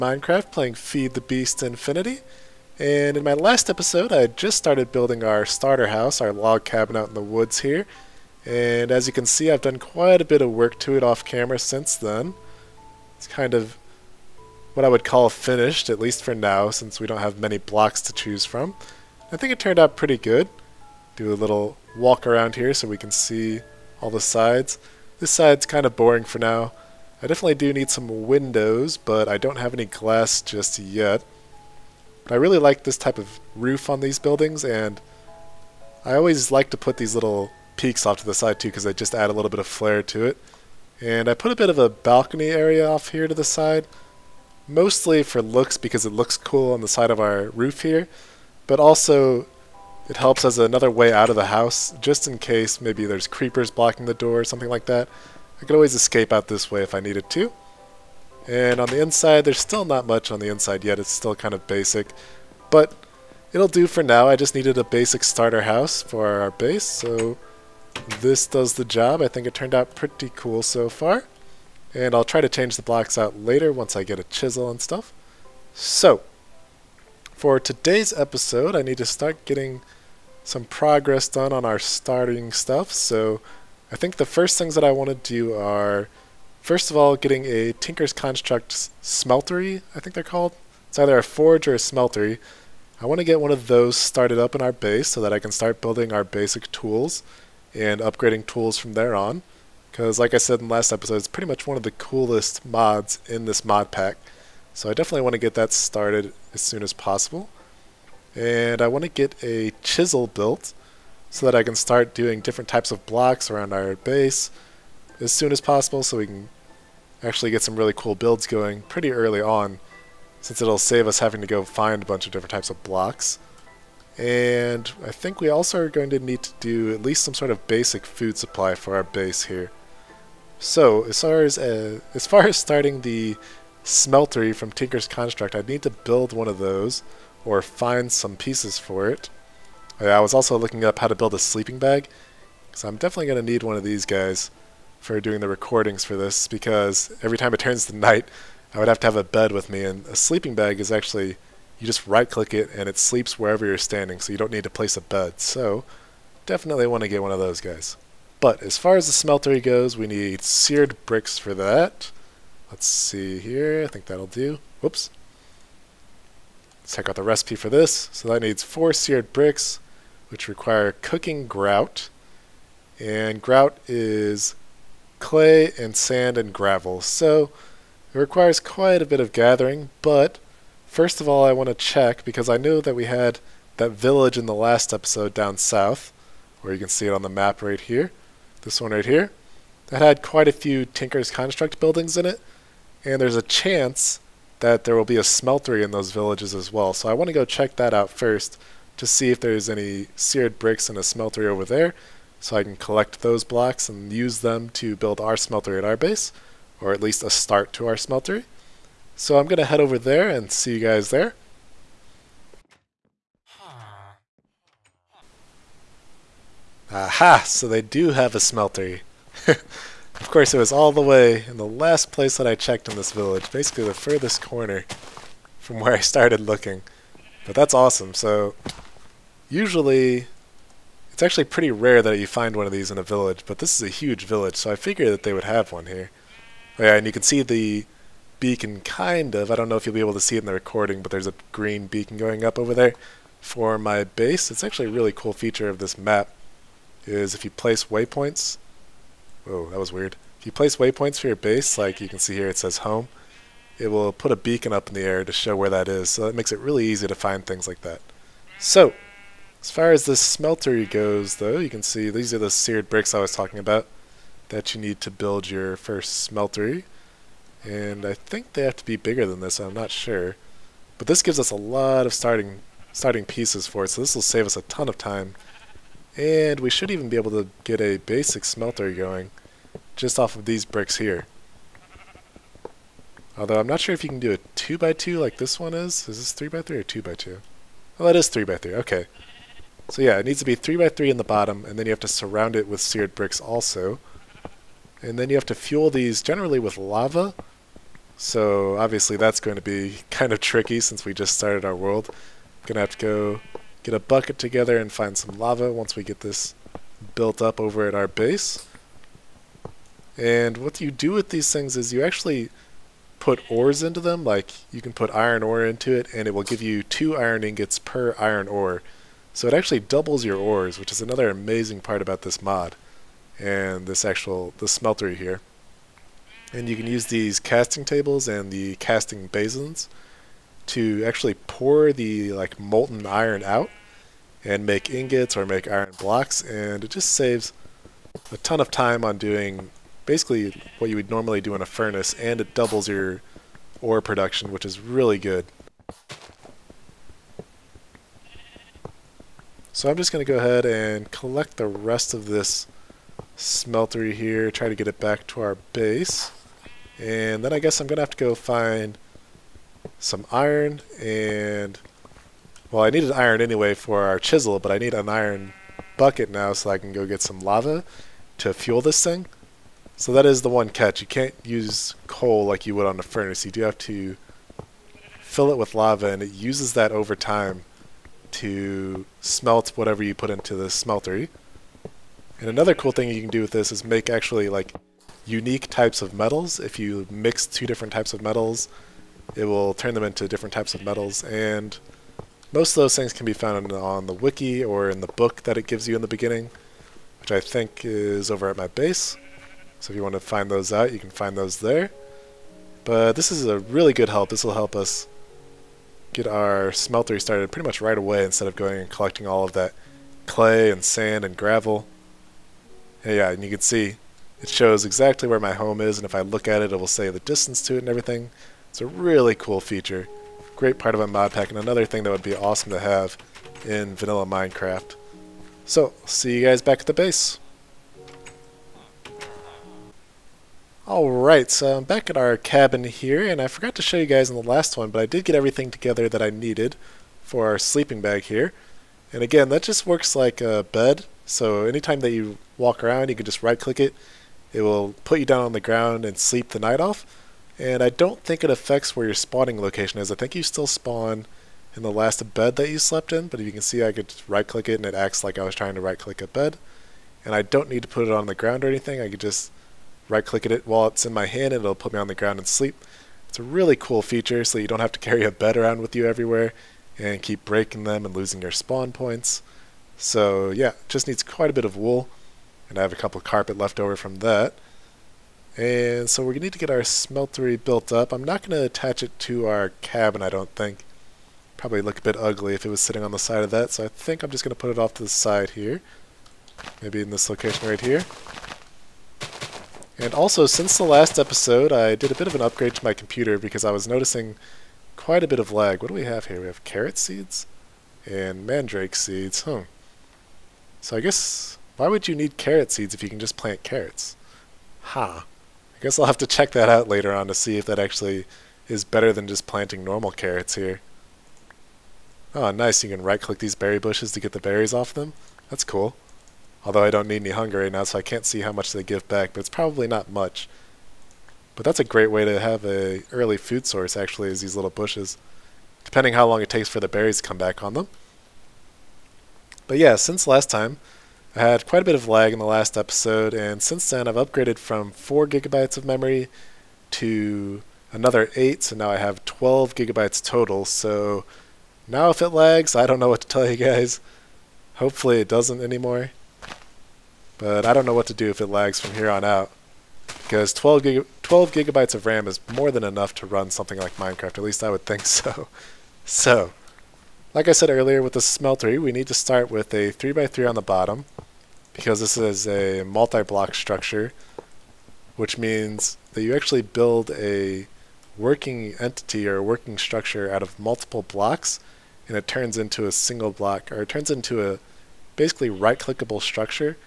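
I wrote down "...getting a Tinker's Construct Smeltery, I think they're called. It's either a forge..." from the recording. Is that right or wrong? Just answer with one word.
right.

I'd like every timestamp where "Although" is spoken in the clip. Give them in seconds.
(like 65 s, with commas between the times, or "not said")
283 s, 516 s.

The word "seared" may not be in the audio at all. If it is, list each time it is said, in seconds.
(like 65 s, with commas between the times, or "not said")
160 s, 168 s, 200 s, 262 s, 292 s.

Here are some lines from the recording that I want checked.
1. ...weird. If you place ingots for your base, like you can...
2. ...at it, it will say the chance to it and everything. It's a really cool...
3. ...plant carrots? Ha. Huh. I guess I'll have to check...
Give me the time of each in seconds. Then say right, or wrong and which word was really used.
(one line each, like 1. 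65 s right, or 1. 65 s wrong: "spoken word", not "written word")
1. 249 s wrong: "waypoints", not "ingots"
2. 416 s wrong: "distance", not "chance"
3. 503 s right.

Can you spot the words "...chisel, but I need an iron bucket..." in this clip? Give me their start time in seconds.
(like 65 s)
364 s.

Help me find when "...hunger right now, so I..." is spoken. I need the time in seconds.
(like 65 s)
517 s.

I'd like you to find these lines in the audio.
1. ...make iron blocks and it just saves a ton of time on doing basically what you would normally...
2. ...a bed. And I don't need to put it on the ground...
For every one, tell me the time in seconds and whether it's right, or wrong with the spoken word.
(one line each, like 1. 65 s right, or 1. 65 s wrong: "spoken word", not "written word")
1. 335 s right
2. 456 s right.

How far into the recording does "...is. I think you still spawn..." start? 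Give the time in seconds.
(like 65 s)
450 s.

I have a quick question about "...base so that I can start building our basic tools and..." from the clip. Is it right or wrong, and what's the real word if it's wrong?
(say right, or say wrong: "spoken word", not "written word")
right.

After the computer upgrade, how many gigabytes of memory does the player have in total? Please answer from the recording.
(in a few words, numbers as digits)
12.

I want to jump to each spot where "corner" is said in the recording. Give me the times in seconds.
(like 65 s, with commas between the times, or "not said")
224 s.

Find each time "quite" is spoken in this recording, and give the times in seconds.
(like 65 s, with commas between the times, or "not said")
9 s, 178 s, 190 s, 471 s, 494 s, 531 s.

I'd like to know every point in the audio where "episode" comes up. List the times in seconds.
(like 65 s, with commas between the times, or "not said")
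3 s, 78 s, 100 s, 184 s, 491 s, 532 s.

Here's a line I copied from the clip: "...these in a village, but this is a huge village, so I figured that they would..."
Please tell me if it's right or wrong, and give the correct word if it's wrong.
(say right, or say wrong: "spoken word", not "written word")
right.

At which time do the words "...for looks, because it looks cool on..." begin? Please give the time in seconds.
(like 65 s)
45 s.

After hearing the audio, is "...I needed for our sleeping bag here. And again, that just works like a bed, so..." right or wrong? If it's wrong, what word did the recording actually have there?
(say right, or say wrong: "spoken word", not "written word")
right.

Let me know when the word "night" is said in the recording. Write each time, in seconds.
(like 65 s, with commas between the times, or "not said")
147 s, 446 s.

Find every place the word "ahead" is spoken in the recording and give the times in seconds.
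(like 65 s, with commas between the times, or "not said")
350 s.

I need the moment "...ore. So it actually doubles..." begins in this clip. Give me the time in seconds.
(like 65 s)
318 s.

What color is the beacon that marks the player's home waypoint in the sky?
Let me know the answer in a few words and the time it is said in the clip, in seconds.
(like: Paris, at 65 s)
green, at 241 s.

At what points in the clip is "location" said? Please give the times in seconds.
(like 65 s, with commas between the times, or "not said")
449 s, 487 s.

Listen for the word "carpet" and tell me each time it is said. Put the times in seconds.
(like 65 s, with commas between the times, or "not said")
473 s.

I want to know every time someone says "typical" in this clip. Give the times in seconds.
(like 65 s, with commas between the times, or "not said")
not said.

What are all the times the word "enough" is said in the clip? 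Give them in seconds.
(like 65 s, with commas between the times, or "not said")
552 s.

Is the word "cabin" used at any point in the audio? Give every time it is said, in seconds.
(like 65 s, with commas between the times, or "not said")
6 s, 432 s, 479 s.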